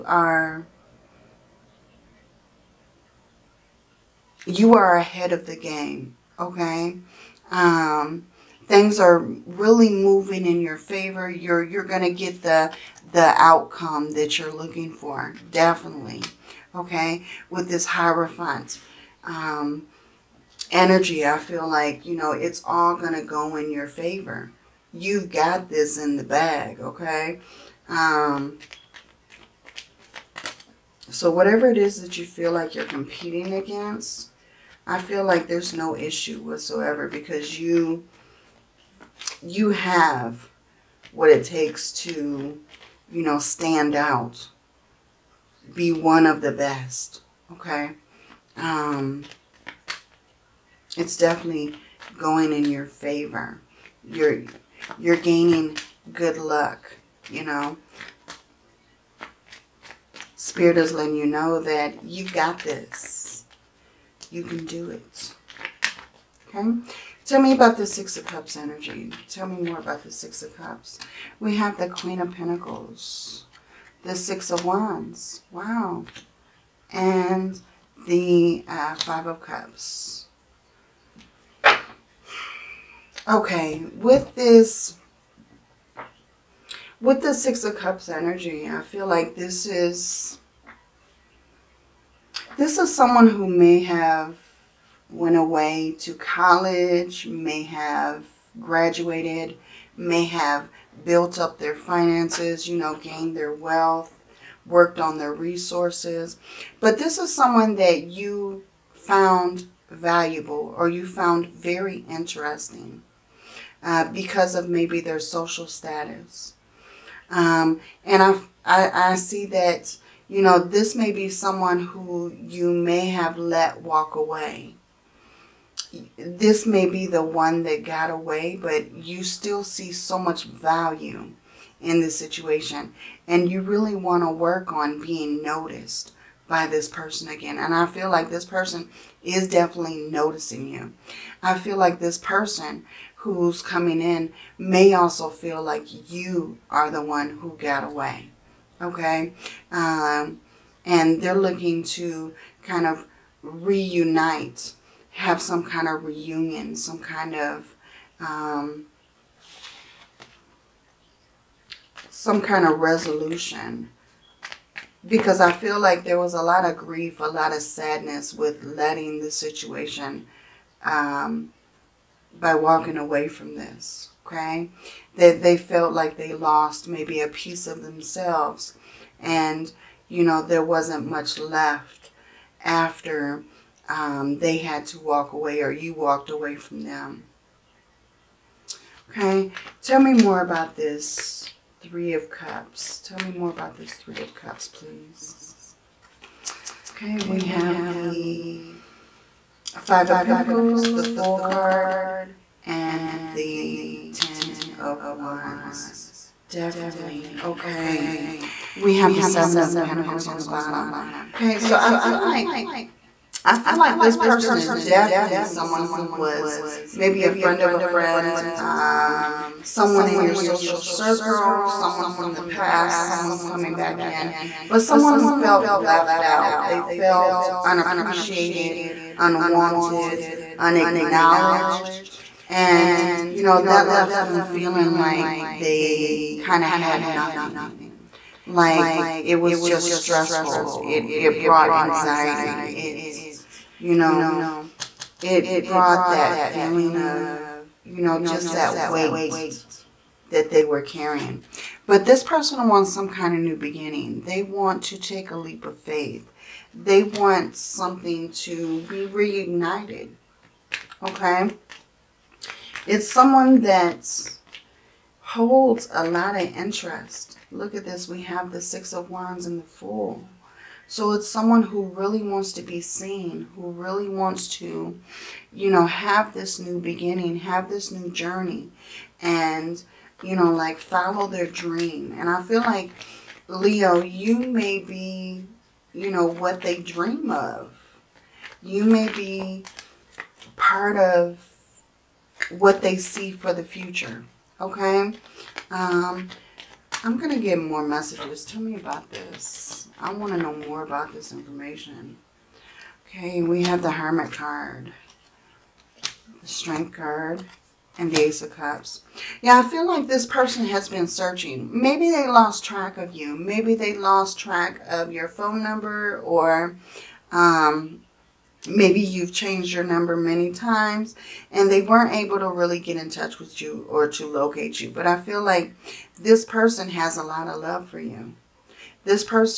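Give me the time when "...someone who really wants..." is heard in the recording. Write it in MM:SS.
04:31.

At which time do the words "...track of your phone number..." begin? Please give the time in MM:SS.
05:14.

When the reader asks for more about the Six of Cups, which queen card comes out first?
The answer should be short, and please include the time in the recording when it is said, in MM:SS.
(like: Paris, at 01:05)
Queen of Pentacles, at 01:11.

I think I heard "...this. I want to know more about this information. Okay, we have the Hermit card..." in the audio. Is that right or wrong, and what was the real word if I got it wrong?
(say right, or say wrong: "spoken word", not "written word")
right.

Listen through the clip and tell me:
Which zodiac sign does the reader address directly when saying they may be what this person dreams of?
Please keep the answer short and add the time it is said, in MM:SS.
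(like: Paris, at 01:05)
Leo, at 04:43.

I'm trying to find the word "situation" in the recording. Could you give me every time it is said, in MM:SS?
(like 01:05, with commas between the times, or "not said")
02:12, 02:49.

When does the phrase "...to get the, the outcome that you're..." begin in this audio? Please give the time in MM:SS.
00:12.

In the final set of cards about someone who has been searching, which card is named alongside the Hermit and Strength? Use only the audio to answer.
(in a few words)
Ace of Cups.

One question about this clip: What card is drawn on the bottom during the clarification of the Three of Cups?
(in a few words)
Seven of Pentacles.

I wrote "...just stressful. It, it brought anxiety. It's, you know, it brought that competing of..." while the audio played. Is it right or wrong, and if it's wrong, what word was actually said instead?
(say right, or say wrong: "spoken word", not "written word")
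wrong: "feeling", not "competing".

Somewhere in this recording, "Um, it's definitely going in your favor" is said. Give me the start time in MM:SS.
00:48.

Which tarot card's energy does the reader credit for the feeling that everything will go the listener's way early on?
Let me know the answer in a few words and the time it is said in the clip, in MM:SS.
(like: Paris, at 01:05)
Hierophant, at 00:17.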